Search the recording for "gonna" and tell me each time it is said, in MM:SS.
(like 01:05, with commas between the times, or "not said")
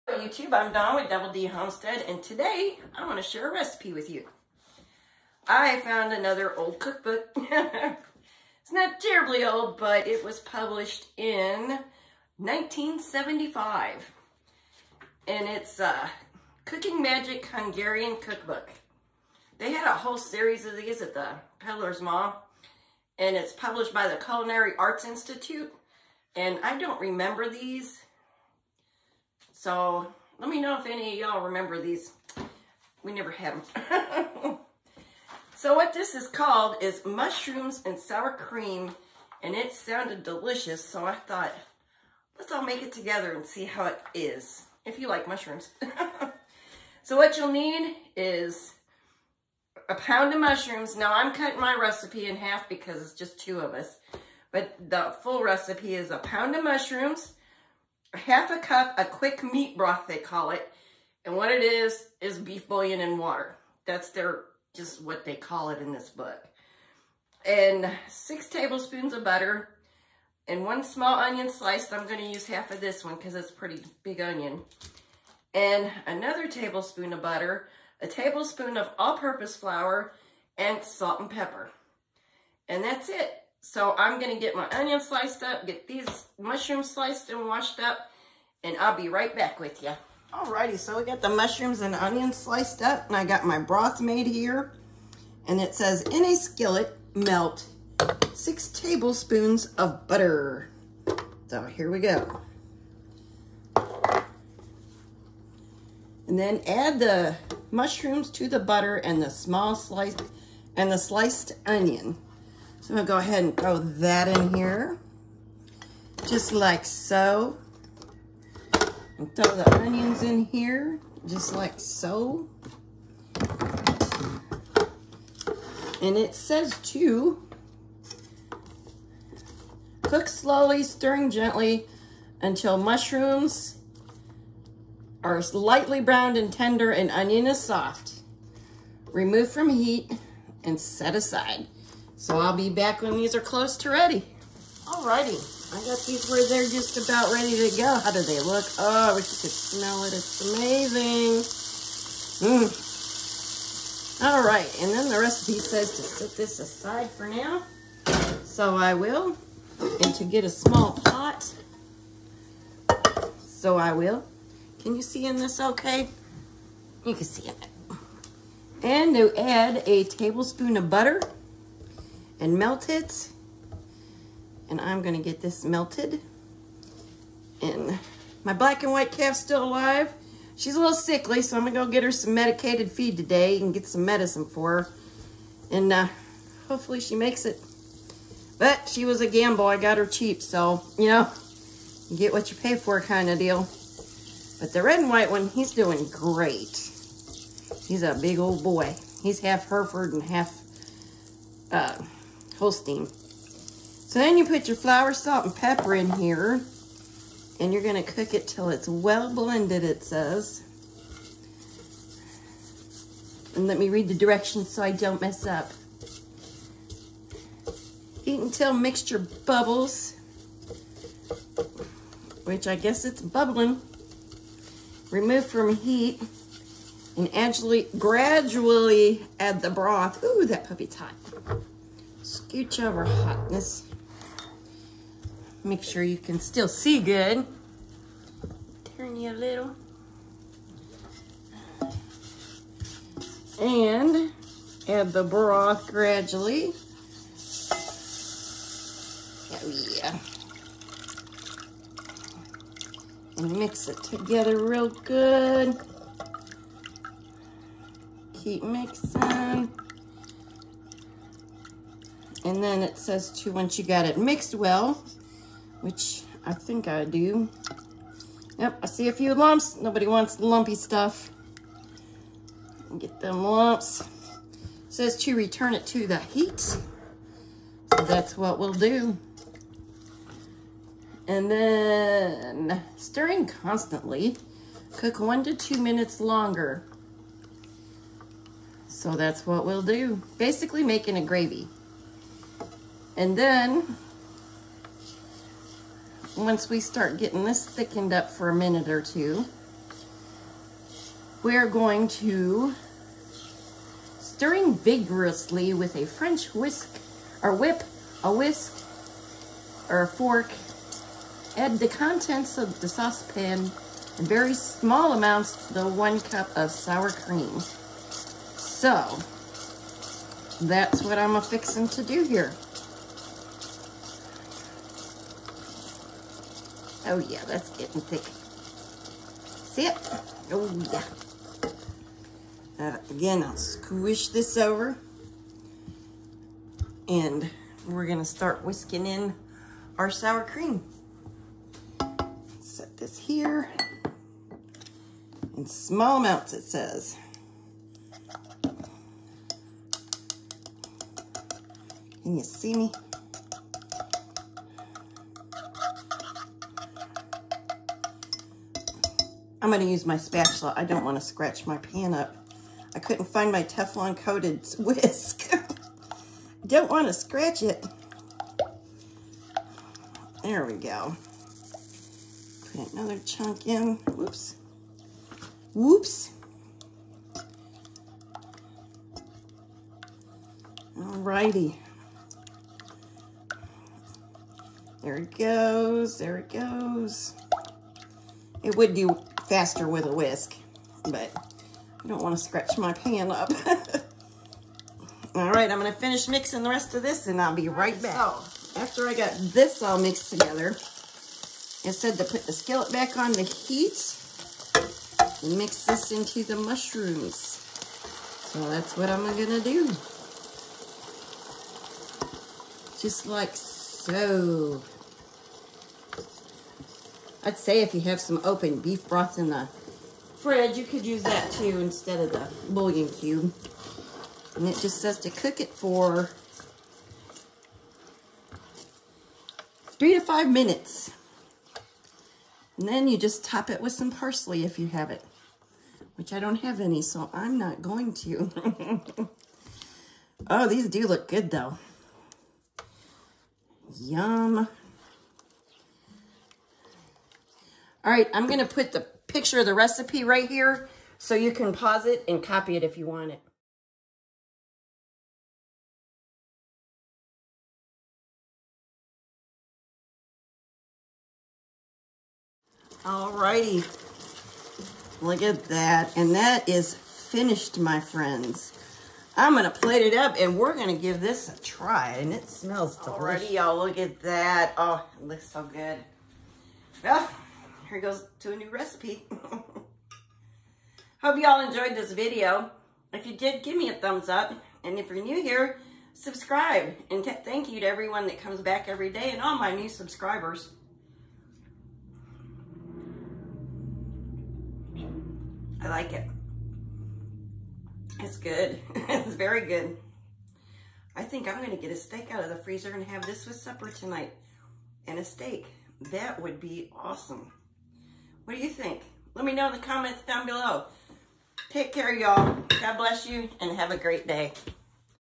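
01:12, 01:24, 01:52, 02:55, 03:01, 05:38, 06:35, 06:49.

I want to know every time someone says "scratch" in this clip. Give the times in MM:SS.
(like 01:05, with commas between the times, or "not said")
06:01, 06:07, 06:32.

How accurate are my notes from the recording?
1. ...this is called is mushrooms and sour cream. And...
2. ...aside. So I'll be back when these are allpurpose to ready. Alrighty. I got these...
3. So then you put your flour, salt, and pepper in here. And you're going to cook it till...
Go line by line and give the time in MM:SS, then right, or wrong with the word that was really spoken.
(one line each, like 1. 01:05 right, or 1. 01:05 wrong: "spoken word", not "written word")
1. 00:35 right
2. 02:21 wrong: "close", not "allpurpose"
3. 03:24 right.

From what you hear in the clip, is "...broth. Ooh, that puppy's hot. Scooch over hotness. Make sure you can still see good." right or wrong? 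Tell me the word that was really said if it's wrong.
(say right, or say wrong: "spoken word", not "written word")
right.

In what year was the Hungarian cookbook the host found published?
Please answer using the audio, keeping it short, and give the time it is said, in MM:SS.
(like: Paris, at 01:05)
1975, at 00:12.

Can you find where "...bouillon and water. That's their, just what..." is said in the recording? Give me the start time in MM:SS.
01:02.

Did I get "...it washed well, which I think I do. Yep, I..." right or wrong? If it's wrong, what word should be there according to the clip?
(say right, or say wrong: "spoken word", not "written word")
wrong: "mixed", not "washed".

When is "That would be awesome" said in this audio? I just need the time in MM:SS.
08:26.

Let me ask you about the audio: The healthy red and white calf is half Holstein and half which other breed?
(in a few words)
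Hereford.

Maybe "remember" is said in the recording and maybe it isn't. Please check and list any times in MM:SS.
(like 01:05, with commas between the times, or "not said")
00:27, 00:31.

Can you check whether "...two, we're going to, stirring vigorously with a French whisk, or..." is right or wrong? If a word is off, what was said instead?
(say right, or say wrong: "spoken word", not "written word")
right.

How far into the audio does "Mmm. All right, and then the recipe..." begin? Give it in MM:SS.
02:32.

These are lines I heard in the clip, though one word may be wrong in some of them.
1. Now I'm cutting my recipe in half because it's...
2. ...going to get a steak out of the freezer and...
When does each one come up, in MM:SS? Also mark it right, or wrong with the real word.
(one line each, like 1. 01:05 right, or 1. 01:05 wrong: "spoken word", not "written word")
1. 00:50 right
2. 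08:21 right.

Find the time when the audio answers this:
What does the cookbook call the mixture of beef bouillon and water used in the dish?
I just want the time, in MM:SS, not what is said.
00:59.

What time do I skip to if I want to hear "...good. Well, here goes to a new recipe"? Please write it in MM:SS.
07:55.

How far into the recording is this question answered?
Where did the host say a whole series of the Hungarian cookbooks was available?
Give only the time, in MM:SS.
00:21.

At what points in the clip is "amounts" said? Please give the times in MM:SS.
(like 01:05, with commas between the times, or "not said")
05:15, 05:46.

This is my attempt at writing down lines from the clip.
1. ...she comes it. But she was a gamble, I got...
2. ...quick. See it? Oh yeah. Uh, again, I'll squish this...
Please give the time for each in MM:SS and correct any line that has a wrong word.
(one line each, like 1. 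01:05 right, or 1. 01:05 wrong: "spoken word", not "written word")
1. 03:07 wrong: "makes", not "comes"
2. 05:28 wrong: "thick", not "quick".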